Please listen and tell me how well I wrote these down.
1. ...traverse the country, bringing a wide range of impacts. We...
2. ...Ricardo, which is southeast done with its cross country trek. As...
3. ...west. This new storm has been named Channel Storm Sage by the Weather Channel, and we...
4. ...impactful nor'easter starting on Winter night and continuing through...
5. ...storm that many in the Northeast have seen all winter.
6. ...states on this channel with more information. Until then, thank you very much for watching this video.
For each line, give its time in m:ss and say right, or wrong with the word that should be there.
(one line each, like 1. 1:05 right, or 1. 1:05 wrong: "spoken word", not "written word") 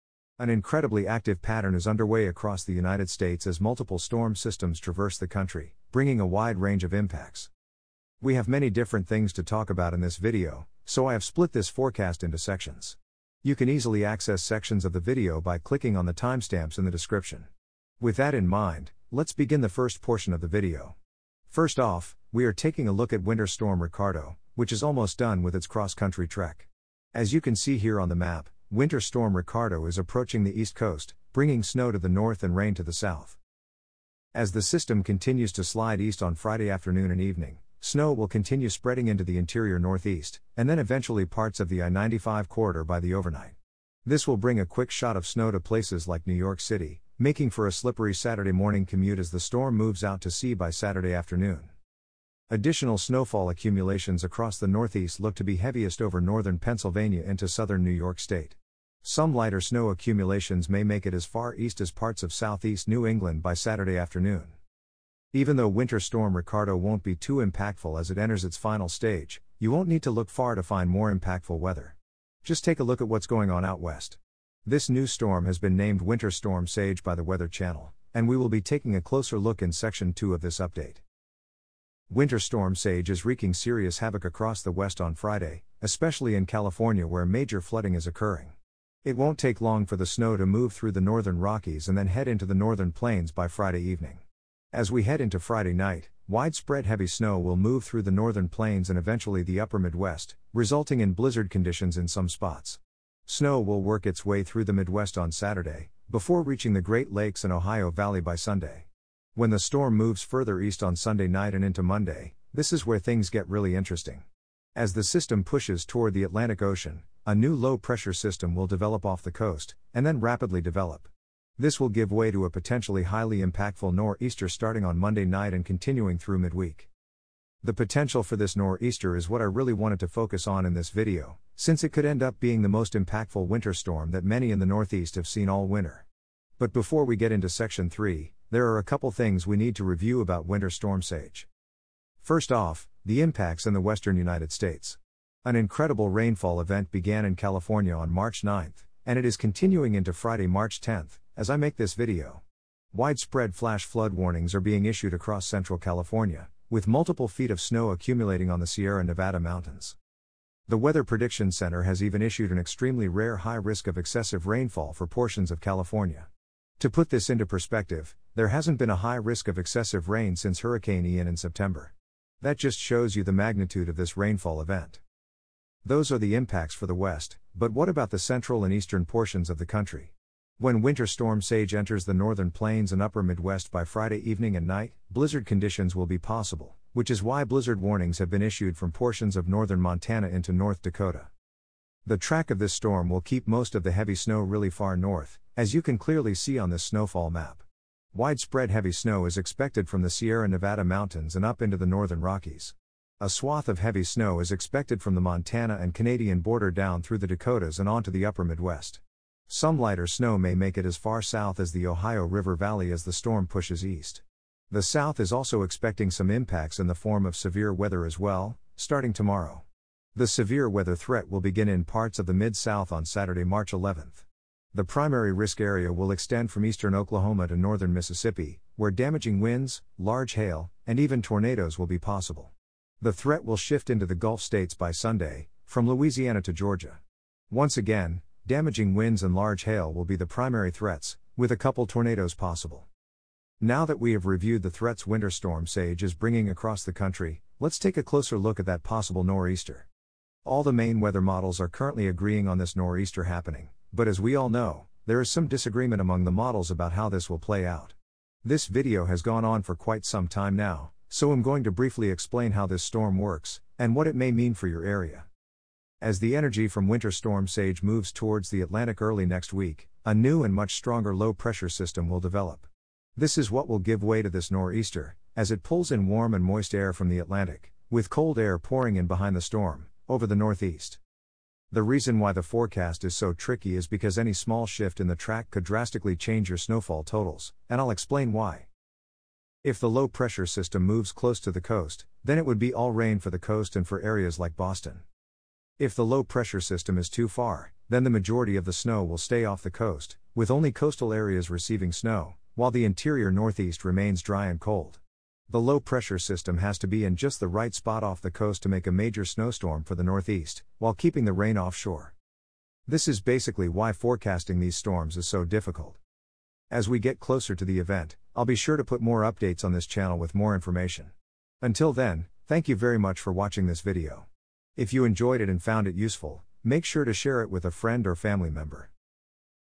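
1. 0:04 right
2. 0:23 wrong: "almost", not "southeast"
3. 1:13 wrong: "Winter", not "Channel"
4. 2:03 wrong: "Monday", not "Winter"
5. 2:13 right
6. 5:19 wrong: "updates", not "states".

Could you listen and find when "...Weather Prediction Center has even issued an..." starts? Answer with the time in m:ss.
2:40.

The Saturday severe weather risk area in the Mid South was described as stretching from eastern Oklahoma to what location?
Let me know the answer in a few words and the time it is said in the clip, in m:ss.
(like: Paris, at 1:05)
Northern Mississippi, at 3:47.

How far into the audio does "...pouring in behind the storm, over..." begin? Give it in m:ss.
4:38.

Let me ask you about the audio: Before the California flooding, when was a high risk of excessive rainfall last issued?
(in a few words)
Hurricane Ian.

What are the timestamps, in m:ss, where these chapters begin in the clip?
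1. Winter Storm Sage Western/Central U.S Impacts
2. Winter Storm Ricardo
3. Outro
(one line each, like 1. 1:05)
1. 1:10
2. 0:20
3. 5:12.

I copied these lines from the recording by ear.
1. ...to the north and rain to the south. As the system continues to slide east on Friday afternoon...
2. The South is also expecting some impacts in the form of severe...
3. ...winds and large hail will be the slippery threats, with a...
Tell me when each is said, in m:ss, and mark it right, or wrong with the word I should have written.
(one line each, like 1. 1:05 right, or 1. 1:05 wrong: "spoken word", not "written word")
1. 0:31 right
2. 3:34 right
3. 3:58 wrong: "primary", not "slippery".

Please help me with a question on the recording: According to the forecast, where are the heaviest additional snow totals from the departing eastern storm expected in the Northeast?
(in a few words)
Northern Pennsylvania.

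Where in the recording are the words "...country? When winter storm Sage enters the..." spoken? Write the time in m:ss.
2:59.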